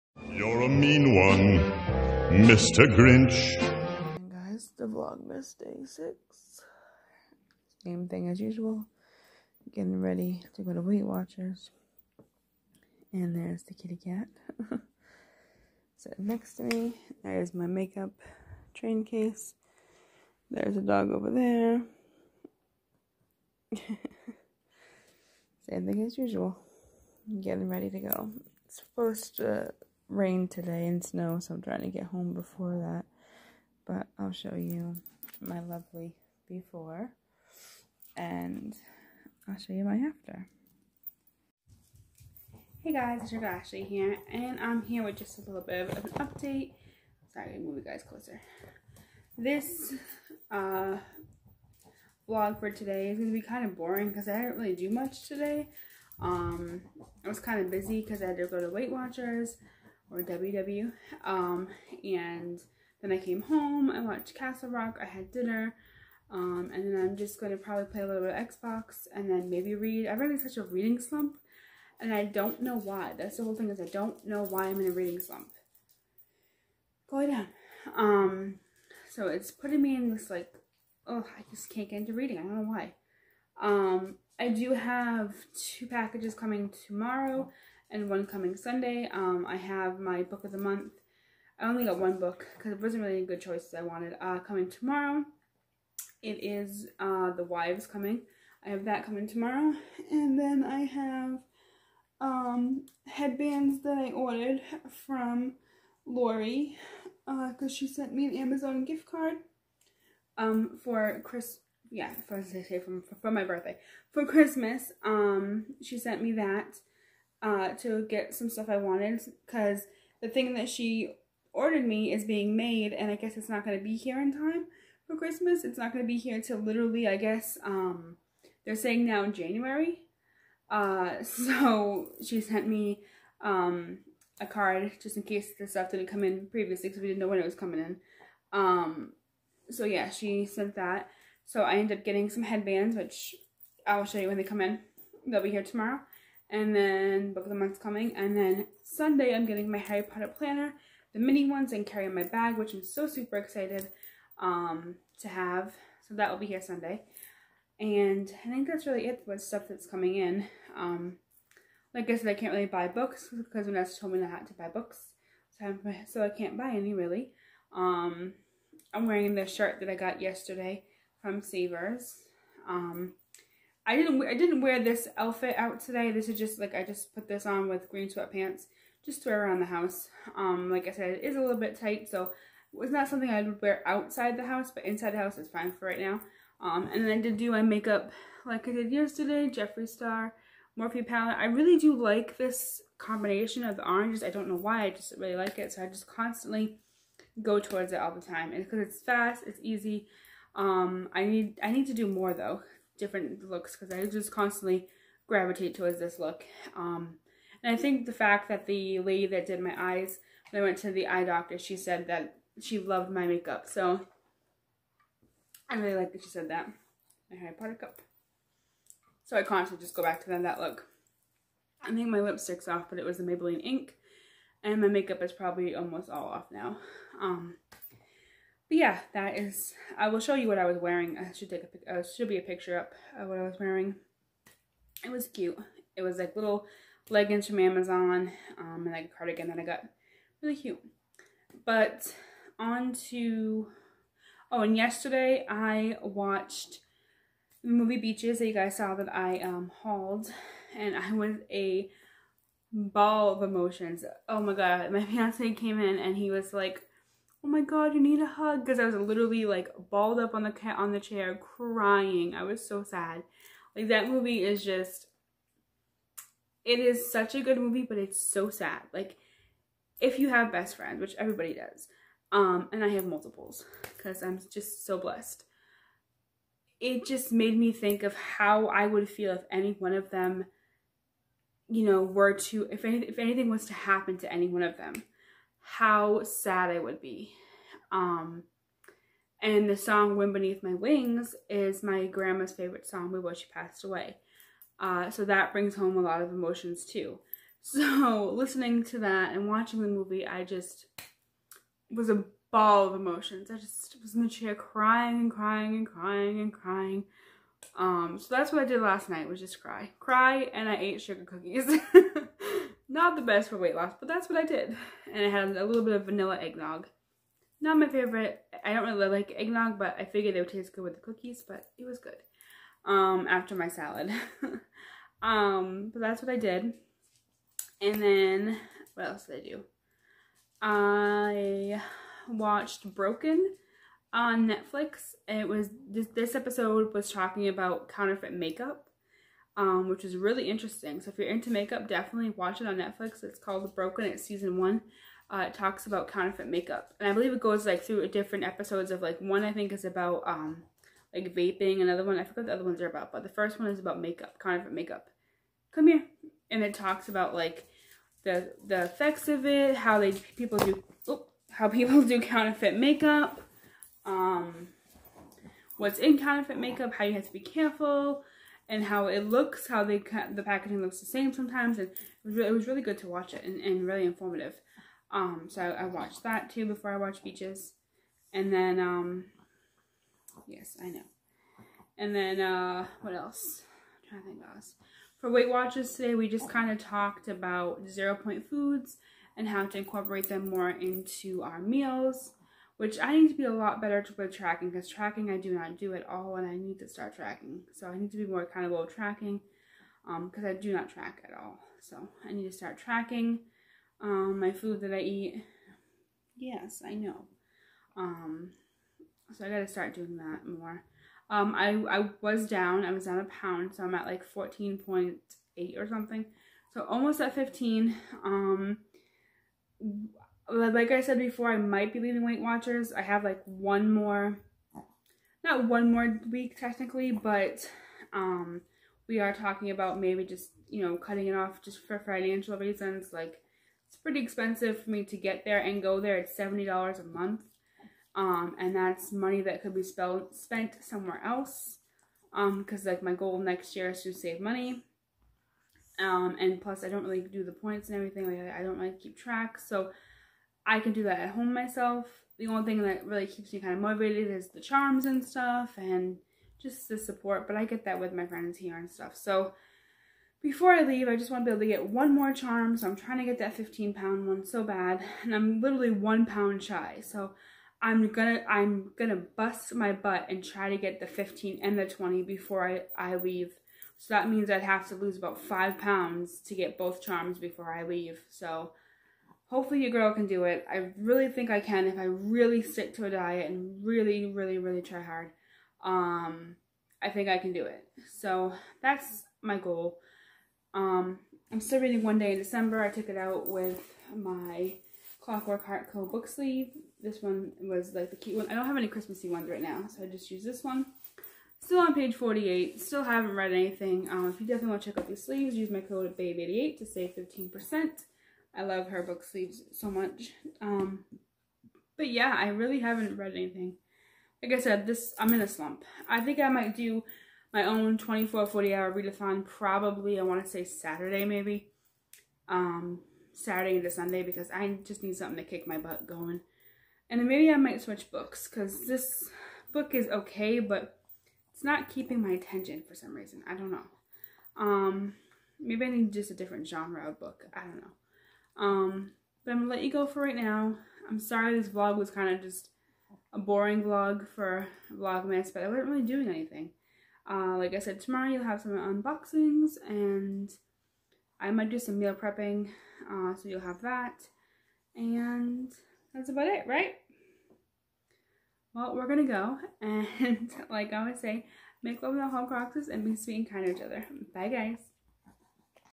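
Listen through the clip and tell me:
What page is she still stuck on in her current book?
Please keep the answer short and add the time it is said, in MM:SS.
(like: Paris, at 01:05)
48, at 08:21.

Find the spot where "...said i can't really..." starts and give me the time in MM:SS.
02:42.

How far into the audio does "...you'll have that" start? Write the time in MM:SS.
09:13.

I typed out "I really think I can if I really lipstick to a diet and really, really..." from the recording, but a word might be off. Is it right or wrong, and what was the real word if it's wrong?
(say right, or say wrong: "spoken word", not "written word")
wrong: "stick", not "lipstick".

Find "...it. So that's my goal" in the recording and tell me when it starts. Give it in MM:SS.
08:07.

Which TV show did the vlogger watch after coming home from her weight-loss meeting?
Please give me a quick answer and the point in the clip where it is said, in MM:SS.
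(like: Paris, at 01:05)
Castle Rock, at 01:04.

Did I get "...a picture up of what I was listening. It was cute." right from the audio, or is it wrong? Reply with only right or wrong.
wrong.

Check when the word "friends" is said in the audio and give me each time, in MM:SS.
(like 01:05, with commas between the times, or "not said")
04:30, 07:38.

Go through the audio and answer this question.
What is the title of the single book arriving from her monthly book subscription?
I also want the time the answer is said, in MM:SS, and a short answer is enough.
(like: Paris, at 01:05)
The Wives, at 01:37.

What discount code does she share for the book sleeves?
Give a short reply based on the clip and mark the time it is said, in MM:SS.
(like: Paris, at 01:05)
BABE88, at 08:26.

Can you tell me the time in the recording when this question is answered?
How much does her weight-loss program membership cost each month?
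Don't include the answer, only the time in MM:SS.
07:16.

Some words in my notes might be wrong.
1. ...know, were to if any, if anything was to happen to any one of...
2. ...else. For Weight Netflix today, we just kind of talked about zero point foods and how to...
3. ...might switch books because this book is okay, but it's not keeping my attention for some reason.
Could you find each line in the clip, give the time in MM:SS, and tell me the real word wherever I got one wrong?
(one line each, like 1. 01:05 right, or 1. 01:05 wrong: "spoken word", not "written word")
1. 04:41 right
2. 06:24 wrong: "Watchers", not "Netflix"
3. 08:47 right.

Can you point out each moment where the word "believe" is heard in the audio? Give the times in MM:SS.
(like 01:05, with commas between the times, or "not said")
05:47.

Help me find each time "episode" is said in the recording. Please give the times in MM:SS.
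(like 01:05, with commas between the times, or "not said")
05:36, 05:48.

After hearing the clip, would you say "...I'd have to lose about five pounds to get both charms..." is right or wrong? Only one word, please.
right.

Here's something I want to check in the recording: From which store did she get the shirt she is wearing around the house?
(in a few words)
Savers.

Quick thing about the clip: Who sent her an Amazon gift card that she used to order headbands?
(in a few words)
Lori.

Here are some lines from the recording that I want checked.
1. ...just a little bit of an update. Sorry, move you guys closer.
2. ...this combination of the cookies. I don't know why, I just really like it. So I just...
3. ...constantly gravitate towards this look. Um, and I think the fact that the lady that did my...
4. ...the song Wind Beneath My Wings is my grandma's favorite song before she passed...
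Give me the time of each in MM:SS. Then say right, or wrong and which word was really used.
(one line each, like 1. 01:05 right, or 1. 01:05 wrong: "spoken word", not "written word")
1. 00:45 right
2. 03:12 wrong: "oranges", not "cookies"
3. 03:24 right
4. 04:49 right.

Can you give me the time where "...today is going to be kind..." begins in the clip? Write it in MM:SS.
00:52.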